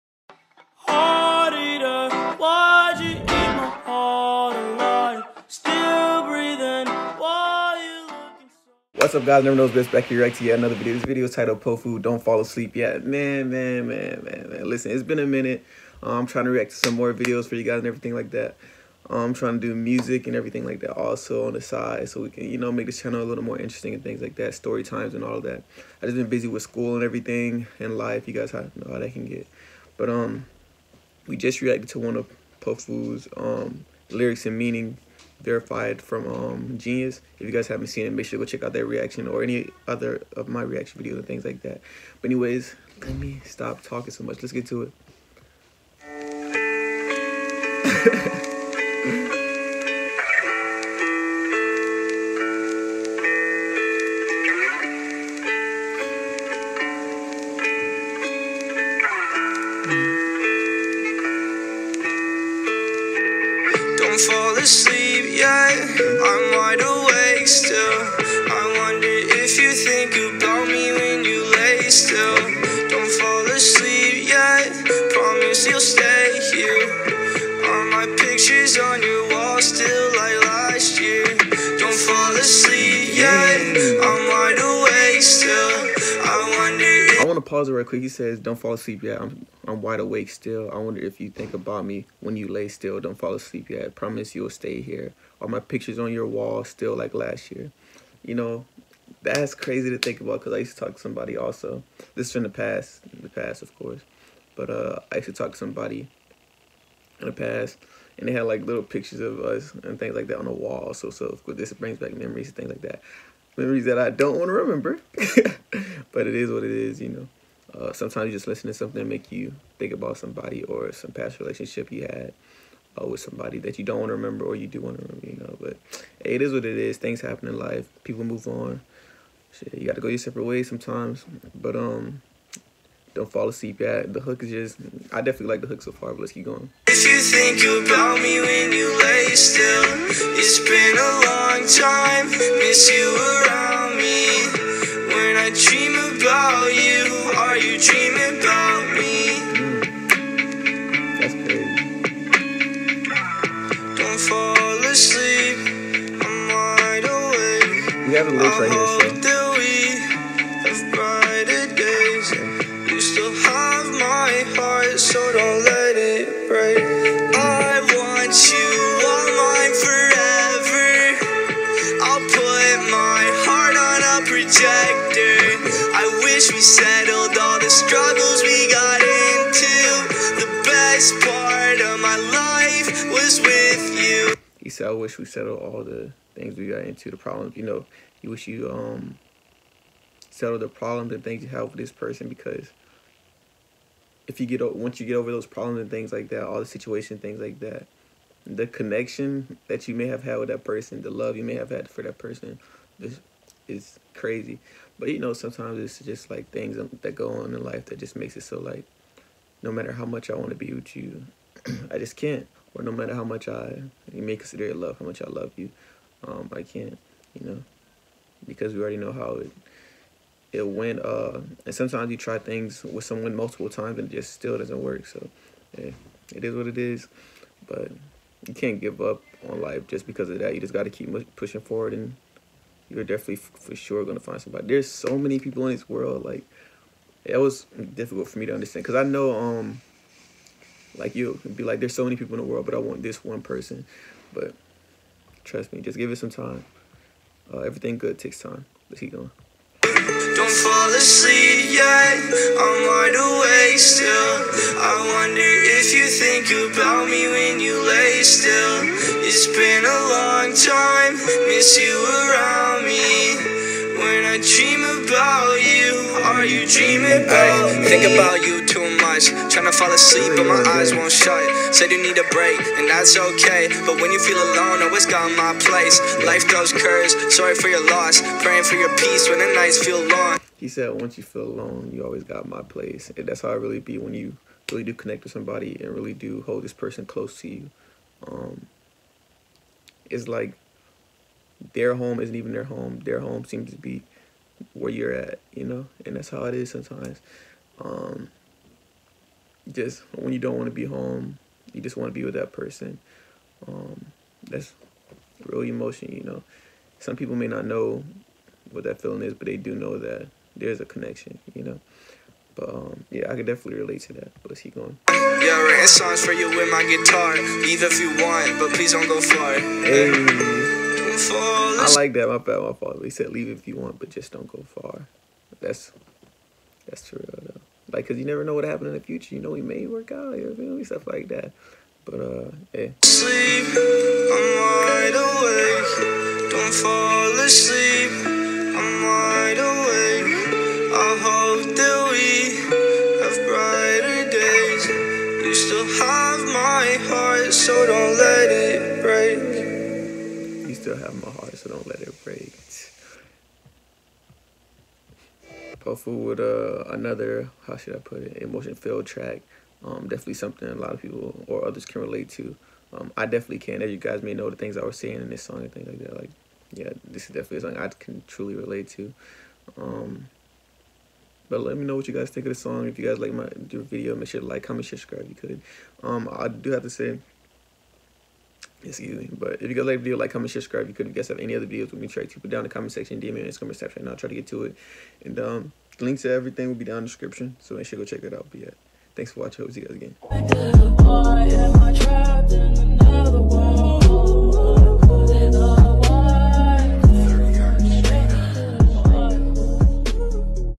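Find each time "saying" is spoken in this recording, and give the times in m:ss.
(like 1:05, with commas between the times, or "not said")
6:04.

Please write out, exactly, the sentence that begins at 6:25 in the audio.
And um, the links to everything will be down in the description.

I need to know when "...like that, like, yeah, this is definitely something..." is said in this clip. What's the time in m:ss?
6:05.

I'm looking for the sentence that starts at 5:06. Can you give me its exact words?
Some people may not know what that feeling is, but they do know that there's a connection, you know.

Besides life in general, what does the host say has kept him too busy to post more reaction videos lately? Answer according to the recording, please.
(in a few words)
School.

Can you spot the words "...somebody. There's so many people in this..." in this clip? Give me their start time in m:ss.
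3:54.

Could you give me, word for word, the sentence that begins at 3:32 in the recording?
Or no matter how much I you may consider it love, how much I love you, um, I can't.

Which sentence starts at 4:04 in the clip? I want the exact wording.
But trust me, just give it some time.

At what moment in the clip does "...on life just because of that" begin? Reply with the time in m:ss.
3:49.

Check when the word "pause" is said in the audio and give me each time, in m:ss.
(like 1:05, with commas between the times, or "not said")
1:27.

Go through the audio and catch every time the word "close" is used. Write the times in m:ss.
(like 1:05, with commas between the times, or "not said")
4:47.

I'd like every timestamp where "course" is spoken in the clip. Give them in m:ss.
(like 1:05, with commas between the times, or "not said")
1:43, 1:51.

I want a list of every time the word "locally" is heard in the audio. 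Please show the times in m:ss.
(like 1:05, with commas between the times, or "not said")
not said.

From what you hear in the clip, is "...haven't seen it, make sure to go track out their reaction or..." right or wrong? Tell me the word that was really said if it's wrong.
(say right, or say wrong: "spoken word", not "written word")
wrong: "check", not "track".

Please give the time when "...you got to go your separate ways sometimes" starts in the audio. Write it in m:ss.
2:09.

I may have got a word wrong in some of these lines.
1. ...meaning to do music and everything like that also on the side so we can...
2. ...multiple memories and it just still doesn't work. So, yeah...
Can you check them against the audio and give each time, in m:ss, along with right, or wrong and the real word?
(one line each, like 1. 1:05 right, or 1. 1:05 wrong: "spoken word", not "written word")
1. 0:19 wrong: "trying", not "meaning"
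2. 3:43 wrong: "times", not "memories".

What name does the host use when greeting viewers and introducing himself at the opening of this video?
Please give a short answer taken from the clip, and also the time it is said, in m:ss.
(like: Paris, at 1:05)
Never Knows Best, at 0:09.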